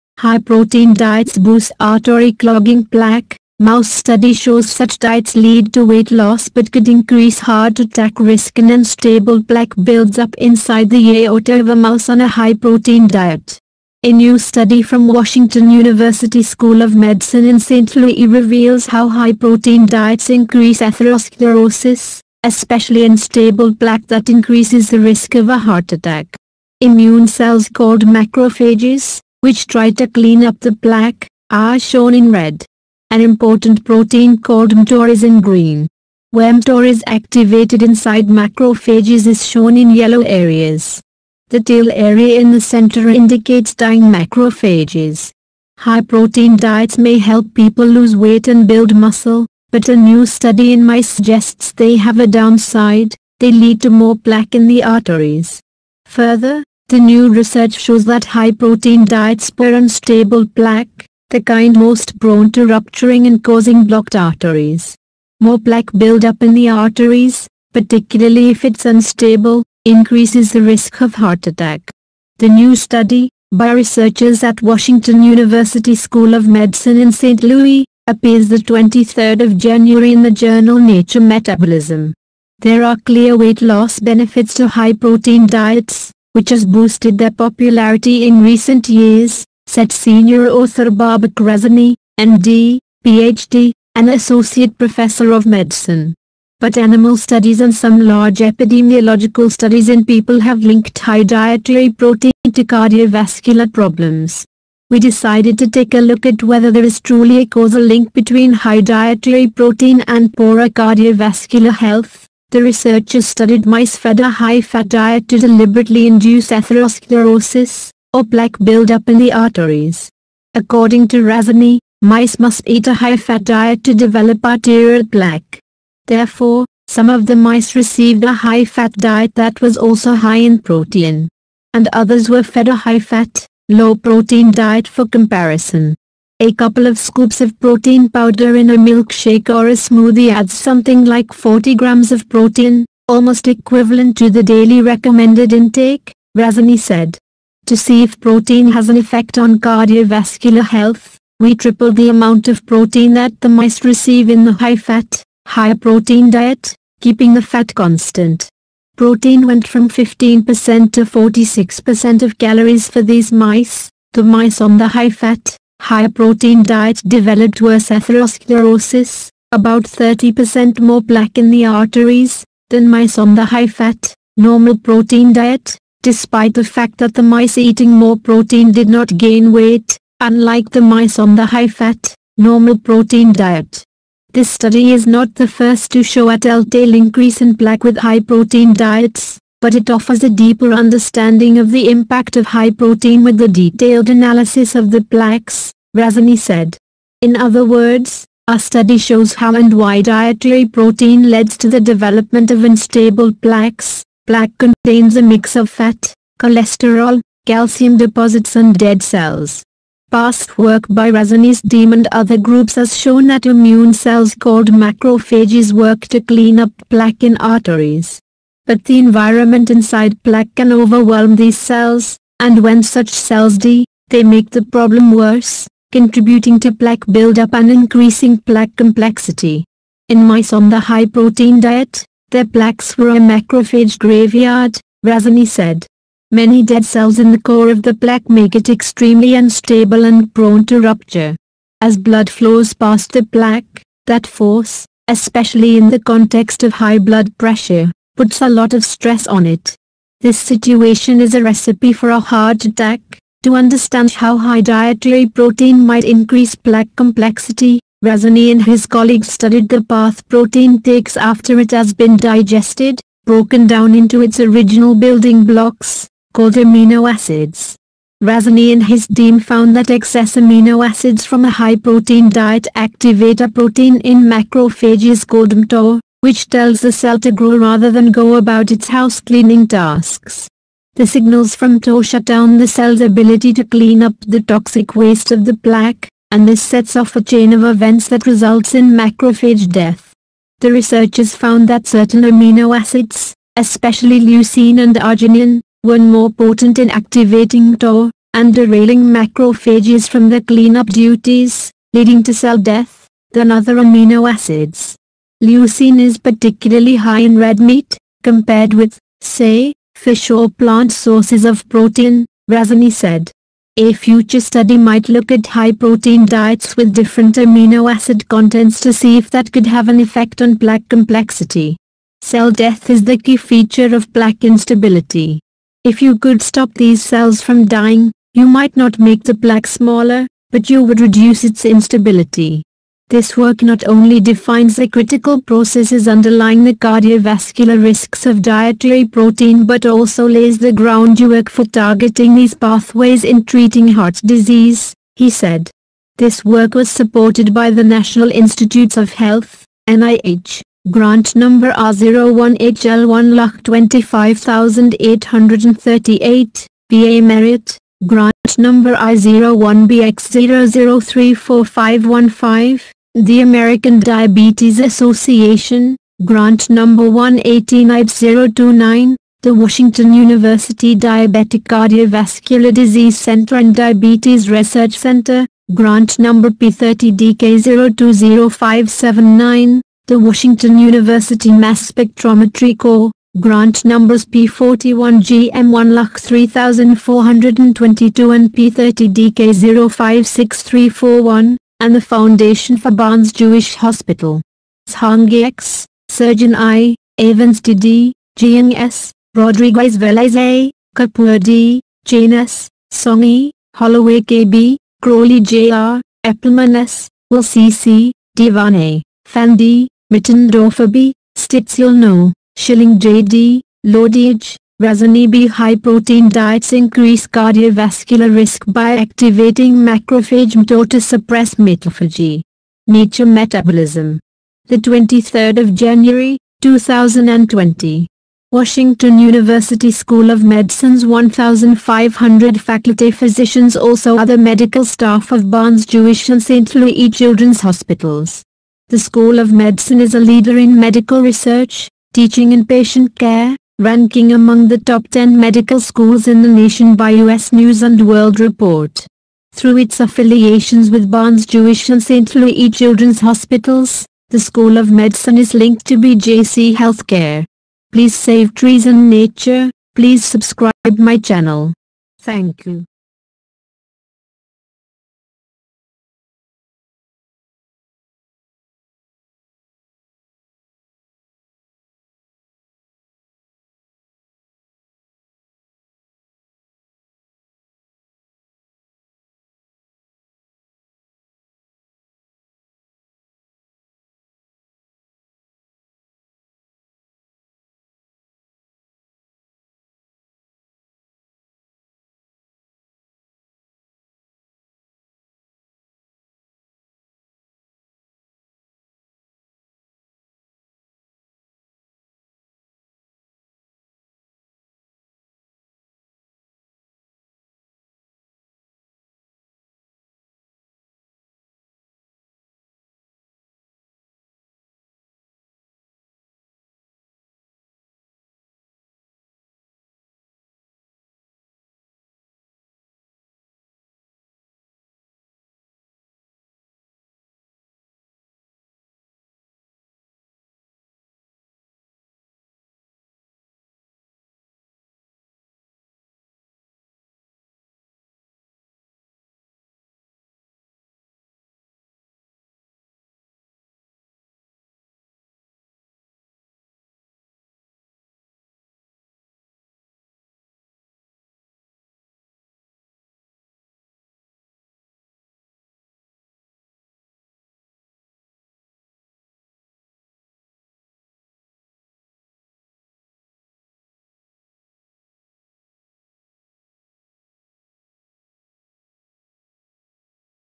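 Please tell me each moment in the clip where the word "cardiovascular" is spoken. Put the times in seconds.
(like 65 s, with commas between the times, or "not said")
102 s, 110 s, 149 s, 336 s, 371 s, 417 s.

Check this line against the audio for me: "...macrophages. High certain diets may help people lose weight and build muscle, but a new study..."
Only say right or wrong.
wrong.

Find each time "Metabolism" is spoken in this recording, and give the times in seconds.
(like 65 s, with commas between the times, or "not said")
81 s, 423 s.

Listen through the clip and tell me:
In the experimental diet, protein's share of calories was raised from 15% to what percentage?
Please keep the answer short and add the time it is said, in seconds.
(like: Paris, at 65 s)
46%, at 161 s.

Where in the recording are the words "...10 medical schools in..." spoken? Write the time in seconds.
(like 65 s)
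445 s.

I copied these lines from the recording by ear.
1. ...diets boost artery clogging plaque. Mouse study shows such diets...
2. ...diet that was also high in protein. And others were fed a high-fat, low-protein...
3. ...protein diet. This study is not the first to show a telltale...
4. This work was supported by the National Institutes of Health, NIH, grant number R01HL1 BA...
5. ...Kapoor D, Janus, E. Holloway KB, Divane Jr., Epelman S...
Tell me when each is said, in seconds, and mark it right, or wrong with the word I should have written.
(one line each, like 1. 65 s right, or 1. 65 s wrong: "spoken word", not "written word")
1. 0 s right
2. 128 s right
3. 182 s right
4. 346 s right
5. 400 s wrong: "Crowley", not "Divane".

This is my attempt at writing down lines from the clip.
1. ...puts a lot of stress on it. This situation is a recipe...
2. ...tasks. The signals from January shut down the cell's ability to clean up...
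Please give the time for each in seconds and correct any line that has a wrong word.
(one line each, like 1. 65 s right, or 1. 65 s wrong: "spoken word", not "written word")
1. 248 s right
2. 279 s wrong: "TOR", not "January".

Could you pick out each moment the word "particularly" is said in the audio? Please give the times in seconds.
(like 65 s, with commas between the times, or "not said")
67 s, 306 s.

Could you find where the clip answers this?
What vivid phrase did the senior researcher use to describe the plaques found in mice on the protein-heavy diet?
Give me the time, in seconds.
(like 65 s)
233 s.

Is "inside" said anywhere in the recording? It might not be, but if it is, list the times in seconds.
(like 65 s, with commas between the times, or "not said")
10 s, 37 s, 219 s.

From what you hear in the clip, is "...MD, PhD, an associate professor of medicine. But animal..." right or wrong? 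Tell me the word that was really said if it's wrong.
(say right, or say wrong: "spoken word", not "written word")
right.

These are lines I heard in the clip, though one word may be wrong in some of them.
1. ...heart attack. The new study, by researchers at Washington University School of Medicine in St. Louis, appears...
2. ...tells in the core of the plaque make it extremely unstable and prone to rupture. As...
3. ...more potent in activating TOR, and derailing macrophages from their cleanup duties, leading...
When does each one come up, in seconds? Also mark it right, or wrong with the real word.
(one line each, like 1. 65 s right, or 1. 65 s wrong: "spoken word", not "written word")
1. 71 s right
2. 236 s wrong: "cells", not "tells"
3. 295 s right.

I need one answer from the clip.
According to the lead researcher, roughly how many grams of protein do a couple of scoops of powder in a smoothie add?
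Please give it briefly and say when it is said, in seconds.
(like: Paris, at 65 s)
40 grams, at 141 s.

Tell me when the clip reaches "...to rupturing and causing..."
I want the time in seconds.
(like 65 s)
62 s.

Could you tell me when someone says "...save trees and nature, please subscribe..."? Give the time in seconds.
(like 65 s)
458 s.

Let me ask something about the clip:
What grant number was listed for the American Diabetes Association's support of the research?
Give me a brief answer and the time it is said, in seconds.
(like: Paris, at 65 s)
118-029, at 367 s.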